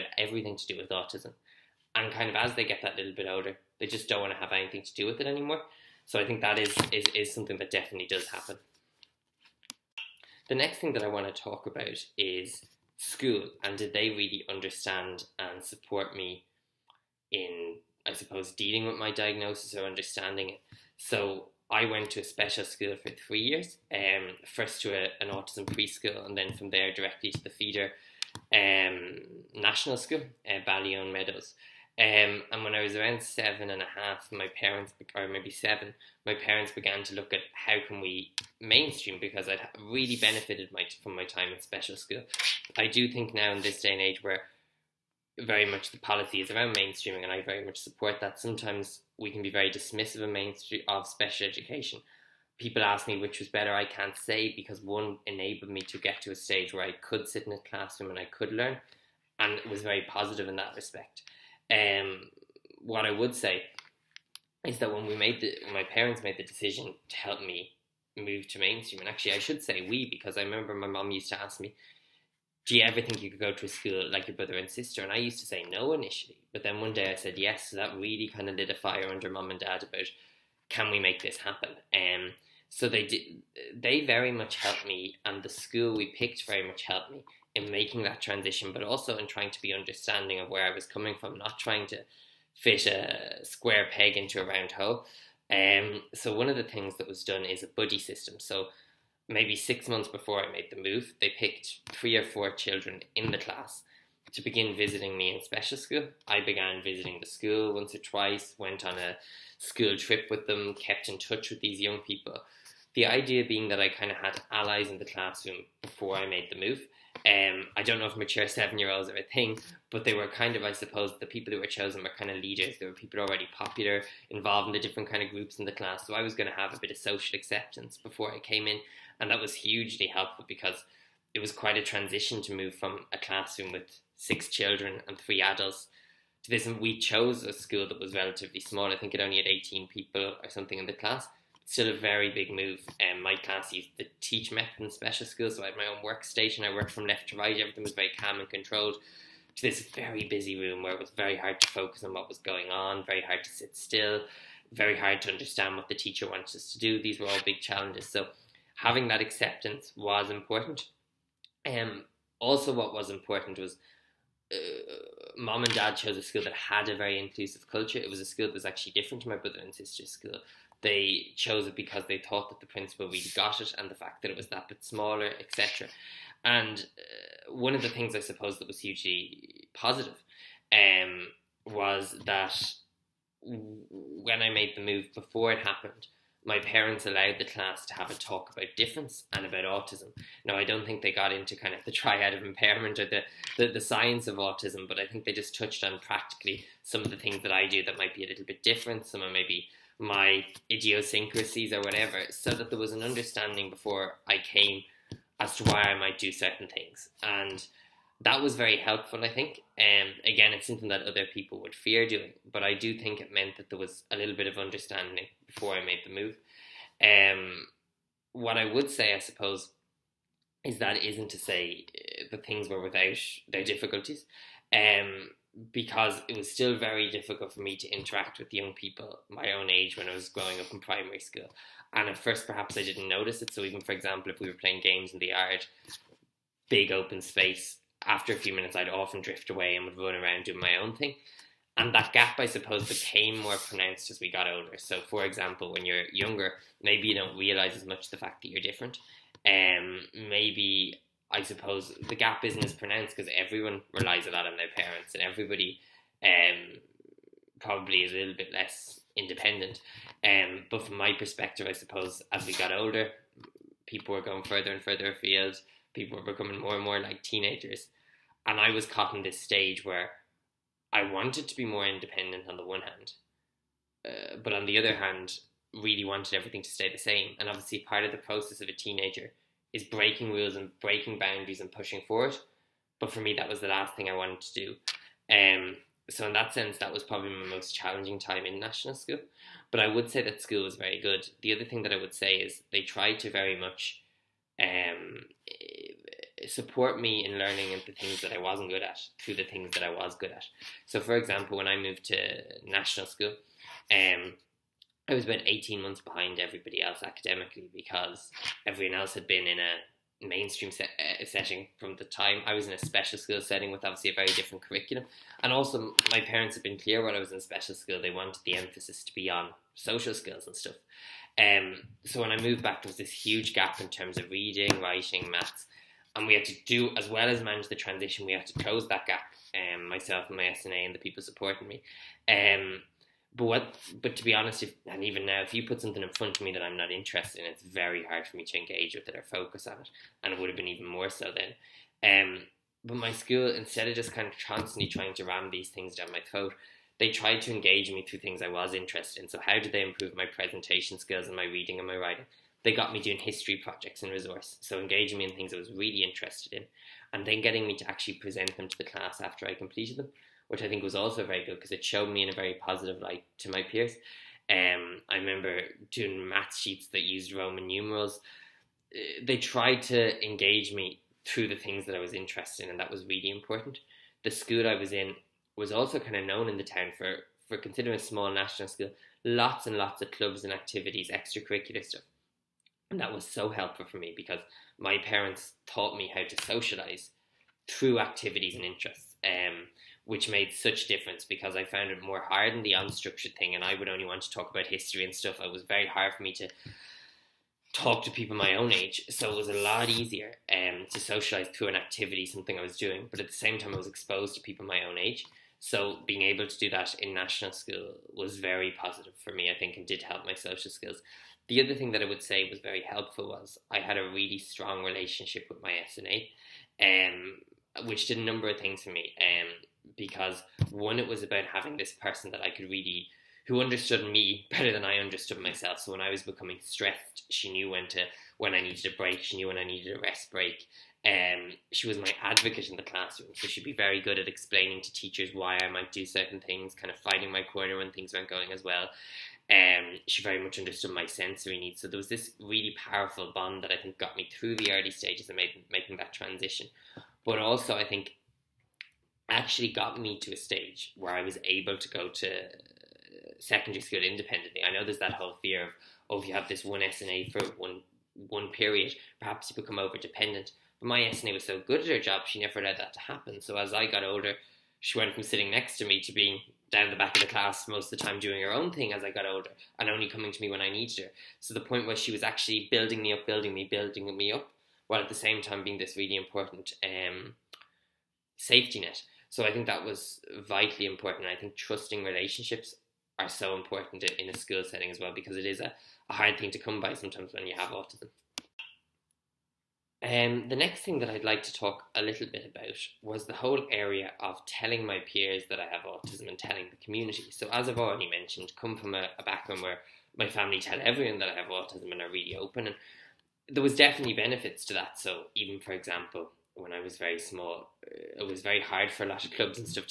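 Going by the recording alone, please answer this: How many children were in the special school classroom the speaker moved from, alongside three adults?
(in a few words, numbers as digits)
6.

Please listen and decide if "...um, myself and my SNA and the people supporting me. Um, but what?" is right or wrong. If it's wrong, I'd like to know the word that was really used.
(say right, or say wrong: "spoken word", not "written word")
right.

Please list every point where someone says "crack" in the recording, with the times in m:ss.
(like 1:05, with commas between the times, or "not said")
not said.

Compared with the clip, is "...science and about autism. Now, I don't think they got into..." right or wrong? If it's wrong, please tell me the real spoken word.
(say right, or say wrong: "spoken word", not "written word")
wrong: "difference", not "science".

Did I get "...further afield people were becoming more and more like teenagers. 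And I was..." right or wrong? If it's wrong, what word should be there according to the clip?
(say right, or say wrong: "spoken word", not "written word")
right.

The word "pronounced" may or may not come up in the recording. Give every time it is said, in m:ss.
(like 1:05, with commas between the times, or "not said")
4:03, 4:12.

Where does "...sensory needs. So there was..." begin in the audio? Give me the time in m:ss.
7:21.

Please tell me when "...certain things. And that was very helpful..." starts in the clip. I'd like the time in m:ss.
3:26.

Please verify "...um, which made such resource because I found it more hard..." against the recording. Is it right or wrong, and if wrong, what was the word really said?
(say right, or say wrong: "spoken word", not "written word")
wrong: "difference", not "resource".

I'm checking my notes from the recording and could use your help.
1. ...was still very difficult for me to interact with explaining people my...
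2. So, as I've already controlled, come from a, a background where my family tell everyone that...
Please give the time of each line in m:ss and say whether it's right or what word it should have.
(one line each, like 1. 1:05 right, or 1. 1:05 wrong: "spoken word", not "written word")
1. 3:46 wrong: "young", not "explaining"
2. 8:17 wrong: "mentioned", not "controlled".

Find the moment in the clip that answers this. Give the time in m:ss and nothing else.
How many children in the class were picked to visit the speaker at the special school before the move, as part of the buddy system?
1:41.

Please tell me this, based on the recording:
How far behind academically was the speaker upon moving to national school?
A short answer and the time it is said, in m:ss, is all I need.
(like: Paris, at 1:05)
18 months, at 5:05.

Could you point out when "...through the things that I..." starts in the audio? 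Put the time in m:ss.
6:11.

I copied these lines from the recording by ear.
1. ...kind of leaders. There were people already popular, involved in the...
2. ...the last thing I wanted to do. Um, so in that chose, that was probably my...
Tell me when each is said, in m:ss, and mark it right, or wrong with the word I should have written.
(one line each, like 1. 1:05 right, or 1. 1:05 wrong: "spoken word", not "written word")
1. 2:02 right
2. 4:43 wrong: "sense", not "chose".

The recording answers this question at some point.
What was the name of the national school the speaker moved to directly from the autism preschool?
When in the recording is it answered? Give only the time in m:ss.
0:30.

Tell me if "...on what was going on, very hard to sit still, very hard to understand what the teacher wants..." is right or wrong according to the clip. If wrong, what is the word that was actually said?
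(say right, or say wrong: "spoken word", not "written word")
right.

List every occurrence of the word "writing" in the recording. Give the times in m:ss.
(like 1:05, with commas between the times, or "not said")
5:24, 5:51.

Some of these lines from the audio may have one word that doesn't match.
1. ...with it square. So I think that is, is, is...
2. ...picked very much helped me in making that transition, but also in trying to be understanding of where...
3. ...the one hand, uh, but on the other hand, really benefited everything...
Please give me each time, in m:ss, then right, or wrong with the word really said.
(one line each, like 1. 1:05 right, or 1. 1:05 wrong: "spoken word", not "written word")
1. 0:05 wrong: "anymore", not "square"
2. 1:26 right
3. 4:32 wrong: "wanted", not "benefited".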